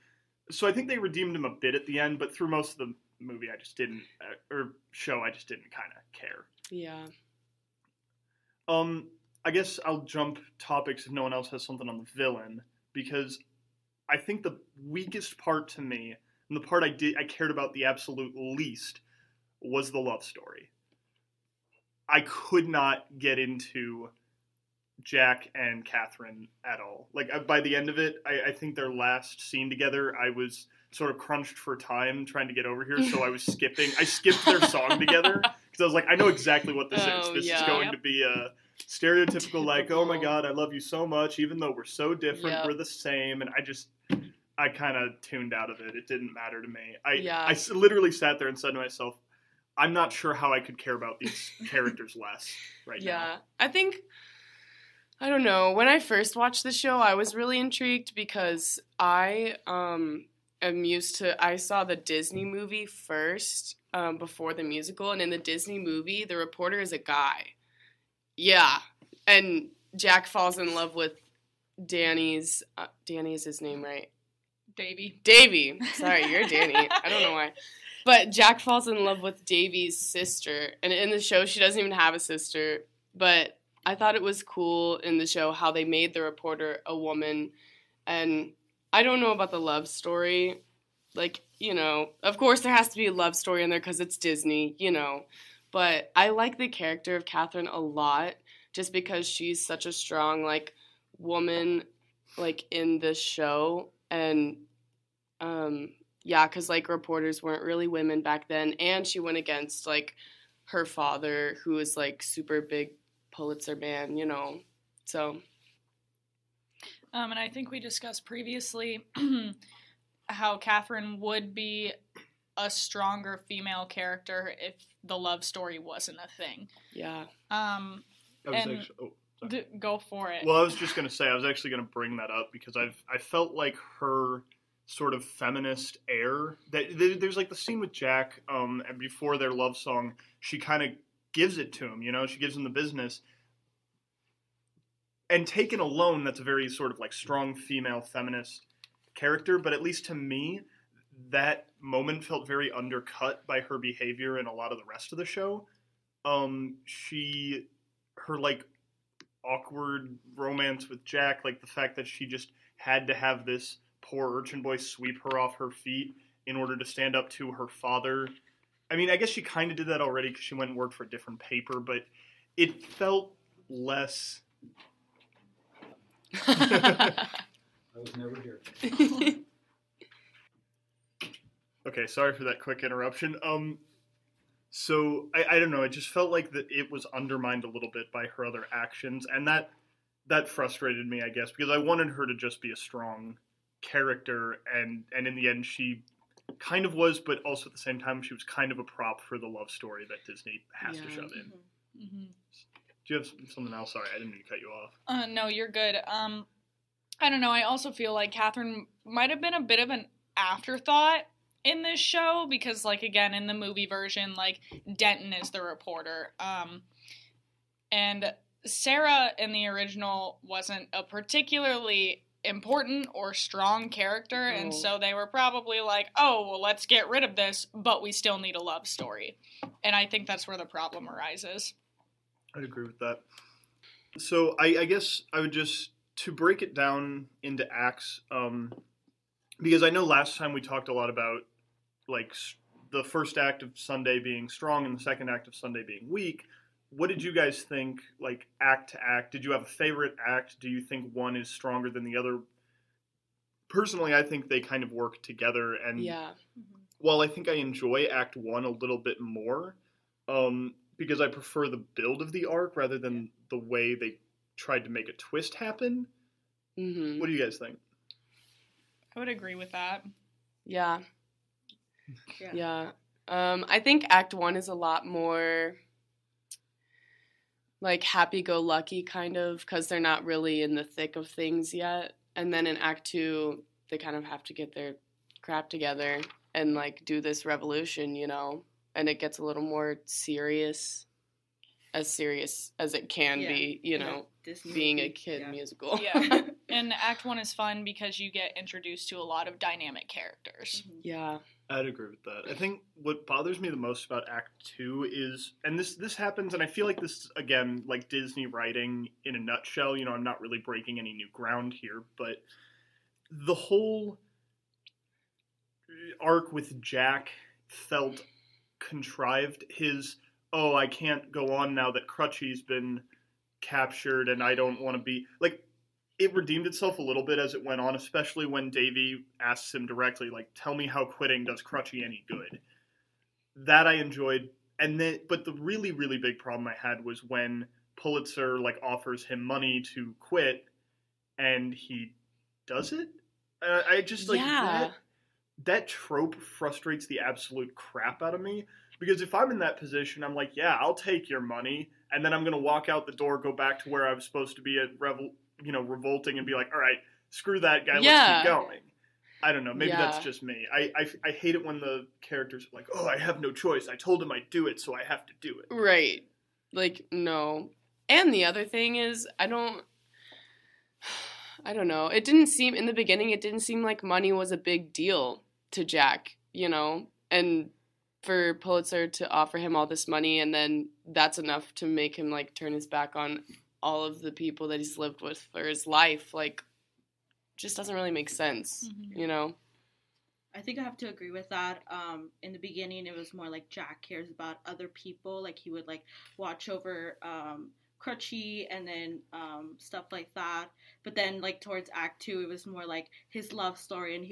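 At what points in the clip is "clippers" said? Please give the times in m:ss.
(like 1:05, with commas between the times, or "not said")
not said.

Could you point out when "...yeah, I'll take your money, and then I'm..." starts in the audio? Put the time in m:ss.
5:50.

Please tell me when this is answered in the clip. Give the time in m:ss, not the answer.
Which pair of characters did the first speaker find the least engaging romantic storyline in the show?
0:25.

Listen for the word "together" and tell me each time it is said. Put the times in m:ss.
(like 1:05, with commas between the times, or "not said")
0:29, 0:34, 4:15, 4:45.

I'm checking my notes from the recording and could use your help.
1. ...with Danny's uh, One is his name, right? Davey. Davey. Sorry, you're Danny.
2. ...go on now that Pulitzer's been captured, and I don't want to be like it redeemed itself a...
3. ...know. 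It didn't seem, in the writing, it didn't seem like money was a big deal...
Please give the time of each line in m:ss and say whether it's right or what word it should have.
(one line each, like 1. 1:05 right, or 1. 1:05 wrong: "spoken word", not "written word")
1. 1:10 wrong: "Danny", not "One"
2. 5:21 wrong: "Crutchy", not "Pulitzer"
3. 6:11 wrong: "beginning", not "writing".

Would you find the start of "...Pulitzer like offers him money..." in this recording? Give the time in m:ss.
5:37.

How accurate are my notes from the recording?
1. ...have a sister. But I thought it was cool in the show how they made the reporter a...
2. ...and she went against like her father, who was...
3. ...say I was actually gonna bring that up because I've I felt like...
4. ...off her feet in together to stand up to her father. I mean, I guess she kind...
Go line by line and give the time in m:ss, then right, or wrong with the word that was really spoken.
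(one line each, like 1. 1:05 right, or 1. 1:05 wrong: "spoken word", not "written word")
1. 1:21 right
2. 1:48 right
3. 2:11 right
4. 2:45 wrong: "order", not "together".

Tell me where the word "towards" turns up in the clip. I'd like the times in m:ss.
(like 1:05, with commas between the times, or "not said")
6:41.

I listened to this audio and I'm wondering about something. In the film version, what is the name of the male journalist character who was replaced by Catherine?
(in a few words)
Denton.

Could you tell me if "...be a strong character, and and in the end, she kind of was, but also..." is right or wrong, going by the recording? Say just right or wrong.
right.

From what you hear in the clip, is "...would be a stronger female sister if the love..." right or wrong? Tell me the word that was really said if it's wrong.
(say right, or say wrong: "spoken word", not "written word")
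wrong: "character", not "sister".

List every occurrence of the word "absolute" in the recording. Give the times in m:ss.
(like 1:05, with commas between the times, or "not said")
0:17, 5:47.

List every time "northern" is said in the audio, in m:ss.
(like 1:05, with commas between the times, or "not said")
not said.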